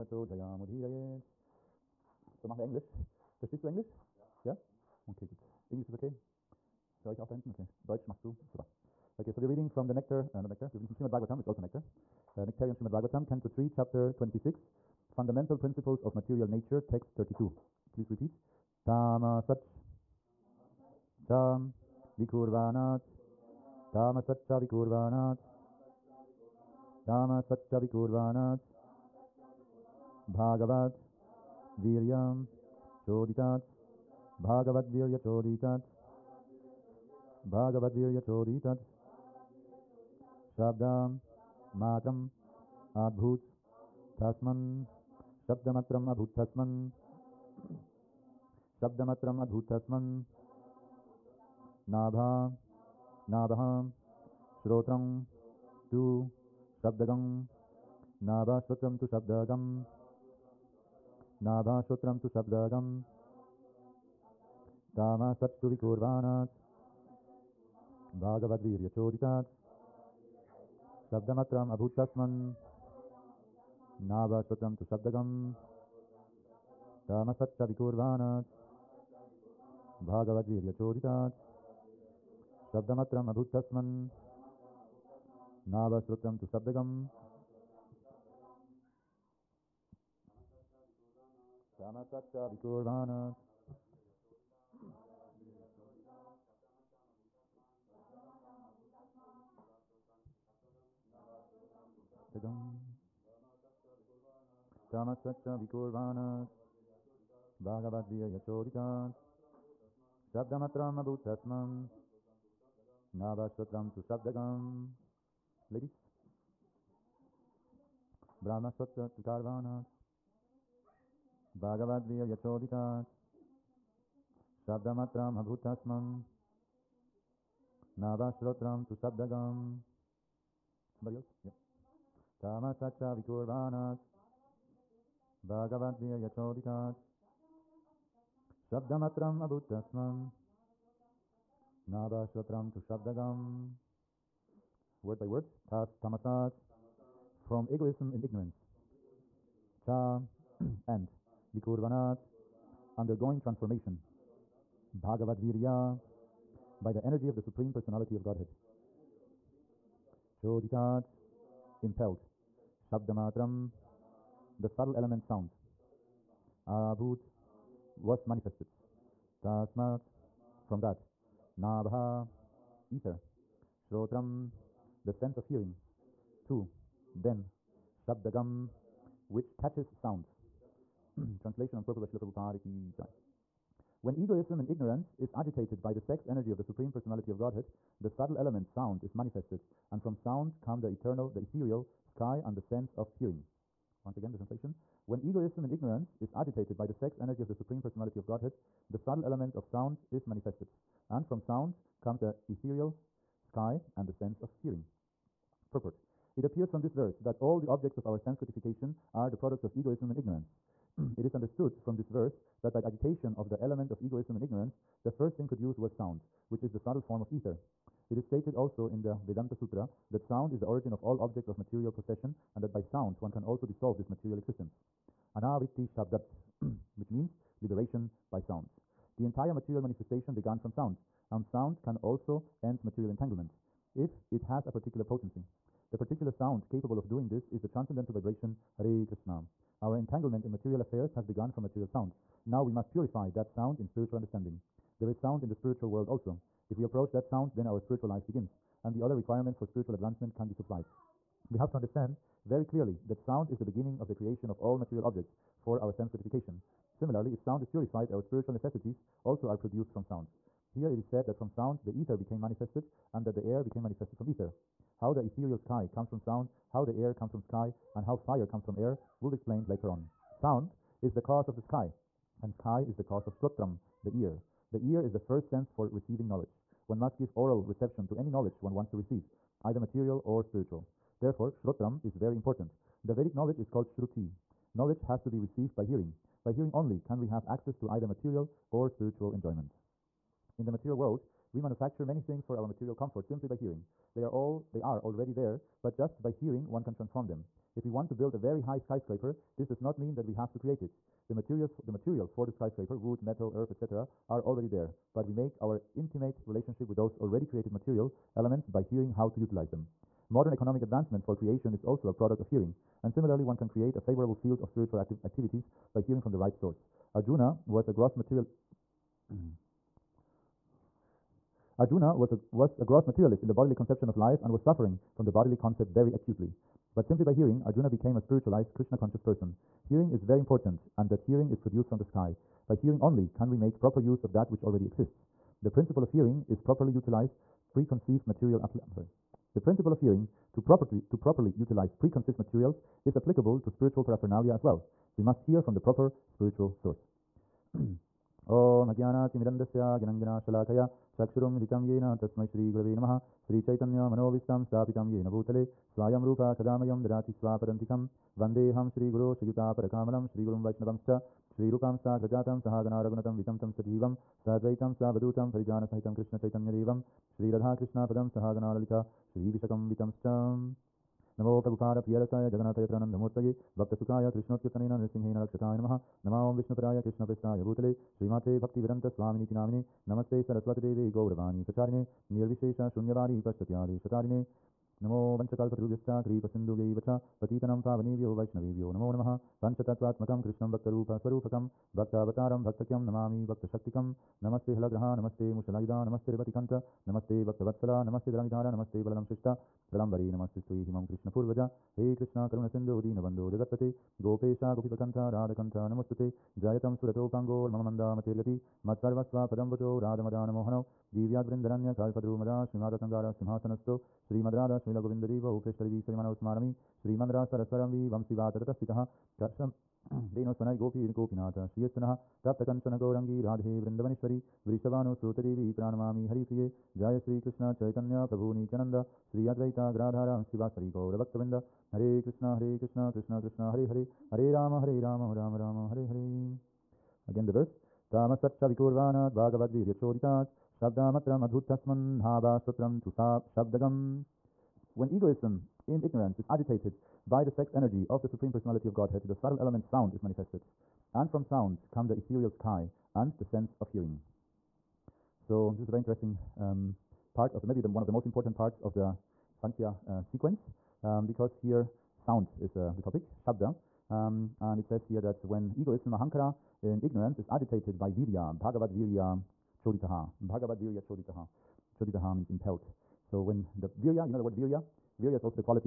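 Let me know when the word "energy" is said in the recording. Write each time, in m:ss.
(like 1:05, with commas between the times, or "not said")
2:37, 3:06, 3:17, 7:27.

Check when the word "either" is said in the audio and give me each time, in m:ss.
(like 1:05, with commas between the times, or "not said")
4:39, 4:47.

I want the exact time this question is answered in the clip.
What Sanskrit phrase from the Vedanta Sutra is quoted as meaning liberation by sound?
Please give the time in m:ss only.
3:45.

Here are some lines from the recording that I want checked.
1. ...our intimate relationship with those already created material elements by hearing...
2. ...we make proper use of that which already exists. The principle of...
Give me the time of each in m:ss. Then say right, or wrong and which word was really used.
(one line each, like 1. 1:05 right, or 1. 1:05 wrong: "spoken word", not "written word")
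1. 5:05 right
2. 5:33 right.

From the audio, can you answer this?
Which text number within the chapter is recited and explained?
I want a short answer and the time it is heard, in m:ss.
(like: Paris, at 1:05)
32, at 0:16.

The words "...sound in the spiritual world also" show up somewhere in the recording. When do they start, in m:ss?
4:05.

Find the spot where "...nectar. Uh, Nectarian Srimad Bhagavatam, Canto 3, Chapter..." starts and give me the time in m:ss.
0:11.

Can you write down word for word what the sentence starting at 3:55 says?
The particular sound capable of doing this is the transcendental vibration Hare Krishna.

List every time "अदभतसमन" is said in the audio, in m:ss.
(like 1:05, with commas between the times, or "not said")
0:49.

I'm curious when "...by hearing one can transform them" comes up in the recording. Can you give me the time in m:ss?
4:56.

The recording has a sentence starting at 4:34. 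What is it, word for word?
The ear is the first sense for receiving knowledge.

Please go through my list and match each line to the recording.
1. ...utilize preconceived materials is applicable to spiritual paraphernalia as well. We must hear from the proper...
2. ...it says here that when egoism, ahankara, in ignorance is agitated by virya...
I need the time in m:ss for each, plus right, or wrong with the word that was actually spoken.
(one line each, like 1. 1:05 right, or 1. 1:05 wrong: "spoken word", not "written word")
1. 5:41 right
2. 7:44 right.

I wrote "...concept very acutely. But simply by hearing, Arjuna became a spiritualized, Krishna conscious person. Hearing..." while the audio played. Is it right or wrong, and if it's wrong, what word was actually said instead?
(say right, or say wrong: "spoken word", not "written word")
right.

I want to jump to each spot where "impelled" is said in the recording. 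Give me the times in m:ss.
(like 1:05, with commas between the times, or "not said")
2:41, 7:52.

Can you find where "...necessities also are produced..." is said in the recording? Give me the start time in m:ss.
4:18.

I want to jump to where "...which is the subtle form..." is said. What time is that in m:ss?
3:36.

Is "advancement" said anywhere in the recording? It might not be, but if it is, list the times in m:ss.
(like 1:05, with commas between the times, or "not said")
4:09, 5:10.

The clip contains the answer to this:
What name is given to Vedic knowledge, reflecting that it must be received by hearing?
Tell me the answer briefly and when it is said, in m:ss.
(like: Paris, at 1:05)
Shruti, at 4:43.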